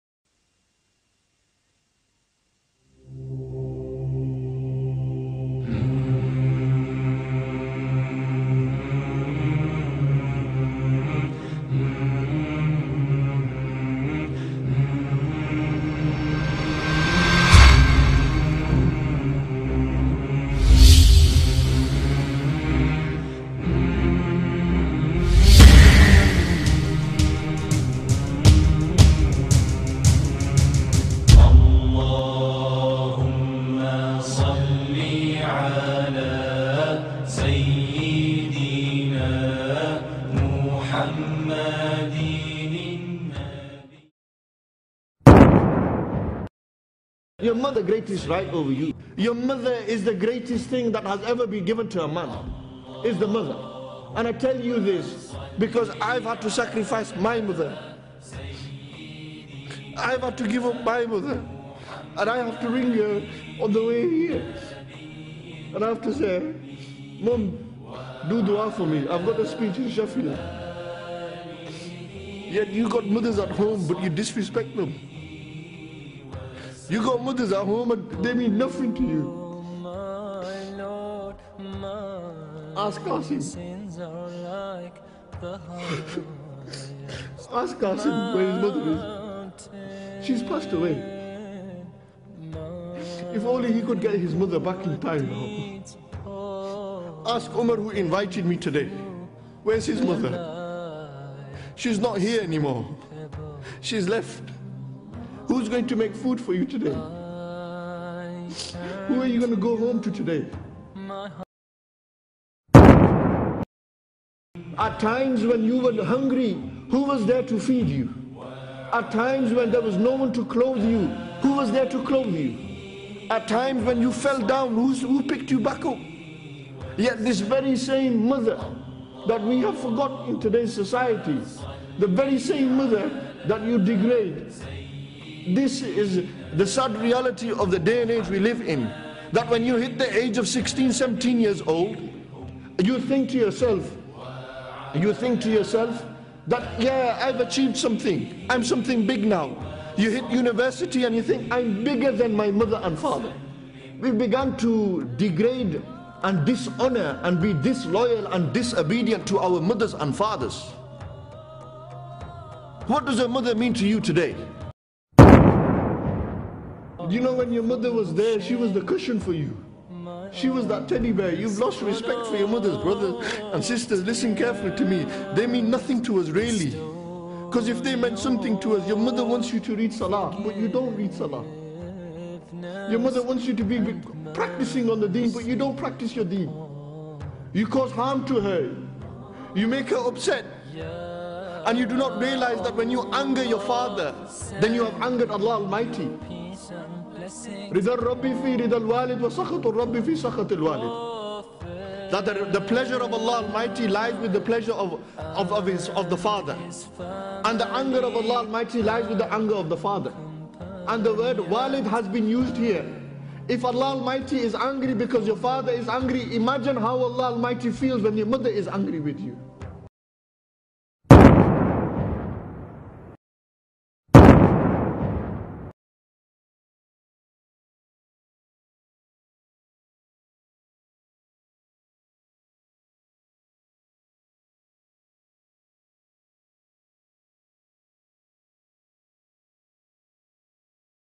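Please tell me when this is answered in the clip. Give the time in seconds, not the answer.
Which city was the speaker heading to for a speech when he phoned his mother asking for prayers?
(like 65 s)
69 s.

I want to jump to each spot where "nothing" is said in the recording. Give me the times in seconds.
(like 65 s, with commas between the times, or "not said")
78 s, 175 s.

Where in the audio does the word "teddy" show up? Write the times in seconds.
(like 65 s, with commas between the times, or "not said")
170 s.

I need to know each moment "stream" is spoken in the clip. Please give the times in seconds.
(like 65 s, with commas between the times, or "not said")
not said.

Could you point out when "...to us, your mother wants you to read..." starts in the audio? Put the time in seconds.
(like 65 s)
178 s.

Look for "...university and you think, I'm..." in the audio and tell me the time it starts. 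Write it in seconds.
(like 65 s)
150 s.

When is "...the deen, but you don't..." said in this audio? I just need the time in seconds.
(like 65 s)
185 s.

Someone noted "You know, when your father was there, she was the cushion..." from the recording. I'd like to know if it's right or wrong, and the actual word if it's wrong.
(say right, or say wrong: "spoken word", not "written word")
wrong: "mother", not "father".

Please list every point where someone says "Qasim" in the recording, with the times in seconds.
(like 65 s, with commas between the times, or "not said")
82 s, 87 s.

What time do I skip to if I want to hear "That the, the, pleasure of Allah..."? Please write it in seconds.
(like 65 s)
202 s.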